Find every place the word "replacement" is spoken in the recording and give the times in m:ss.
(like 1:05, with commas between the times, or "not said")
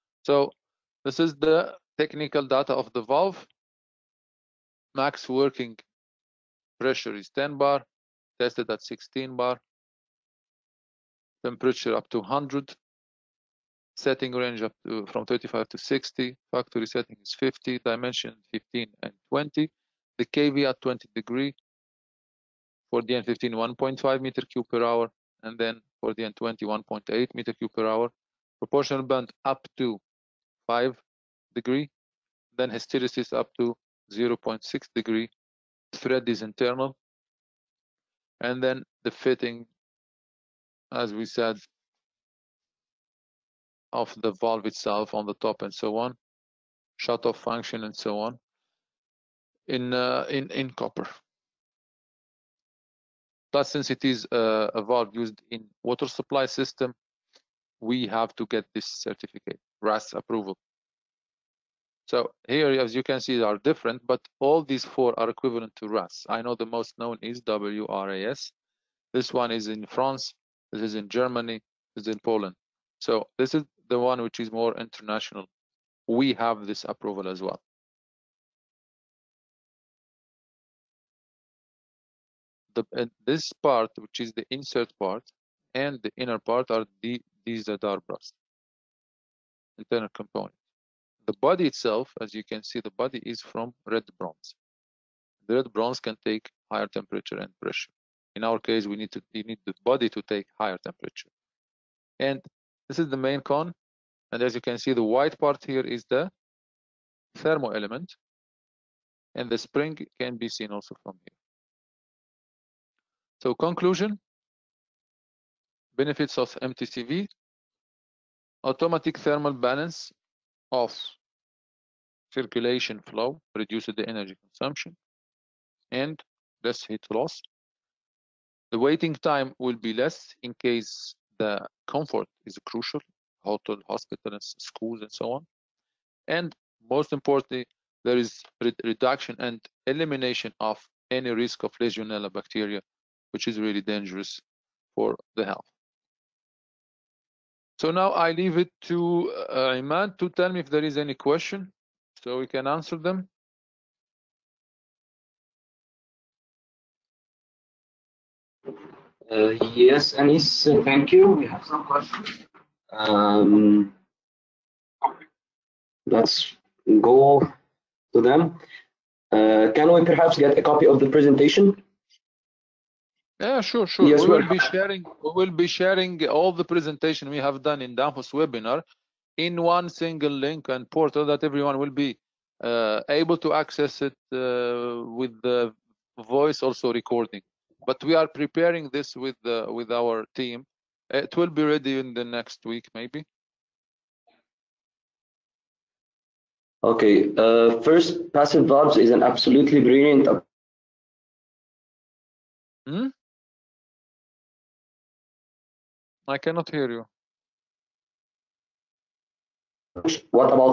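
not said.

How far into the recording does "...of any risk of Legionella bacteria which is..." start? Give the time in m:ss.
2:20.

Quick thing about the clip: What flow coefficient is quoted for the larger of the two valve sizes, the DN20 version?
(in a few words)
1.8 cubic meters per hour.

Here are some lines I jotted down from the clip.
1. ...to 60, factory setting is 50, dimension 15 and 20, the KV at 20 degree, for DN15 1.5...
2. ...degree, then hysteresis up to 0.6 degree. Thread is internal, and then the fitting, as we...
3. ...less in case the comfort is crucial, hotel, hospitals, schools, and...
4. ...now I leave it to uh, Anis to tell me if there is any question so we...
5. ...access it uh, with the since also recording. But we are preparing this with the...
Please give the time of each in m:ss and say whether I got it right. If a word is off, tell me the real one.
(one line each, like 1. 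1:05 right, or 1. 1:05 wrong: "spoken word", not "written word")
1. 0:15 right
2. 0:31 right
3. 2:09 right
4. 2:27 wrong: "Iman", not "Anis"
5. 3:03 wrong: "voice", not "since".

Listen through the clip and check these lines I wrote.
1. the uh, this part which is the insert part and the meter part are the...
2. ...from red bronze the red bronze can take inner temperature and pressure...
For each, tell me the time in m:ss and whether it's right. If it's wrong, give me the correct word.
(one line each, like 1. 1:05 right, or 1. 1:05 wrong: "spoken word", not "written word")
1. 1:22 wrong: "inner", not "meter"
2. 1:33 wrong: "higher", not "inner".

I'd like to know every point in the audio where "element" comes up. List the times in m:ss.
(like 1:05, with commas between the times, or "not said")
1:47.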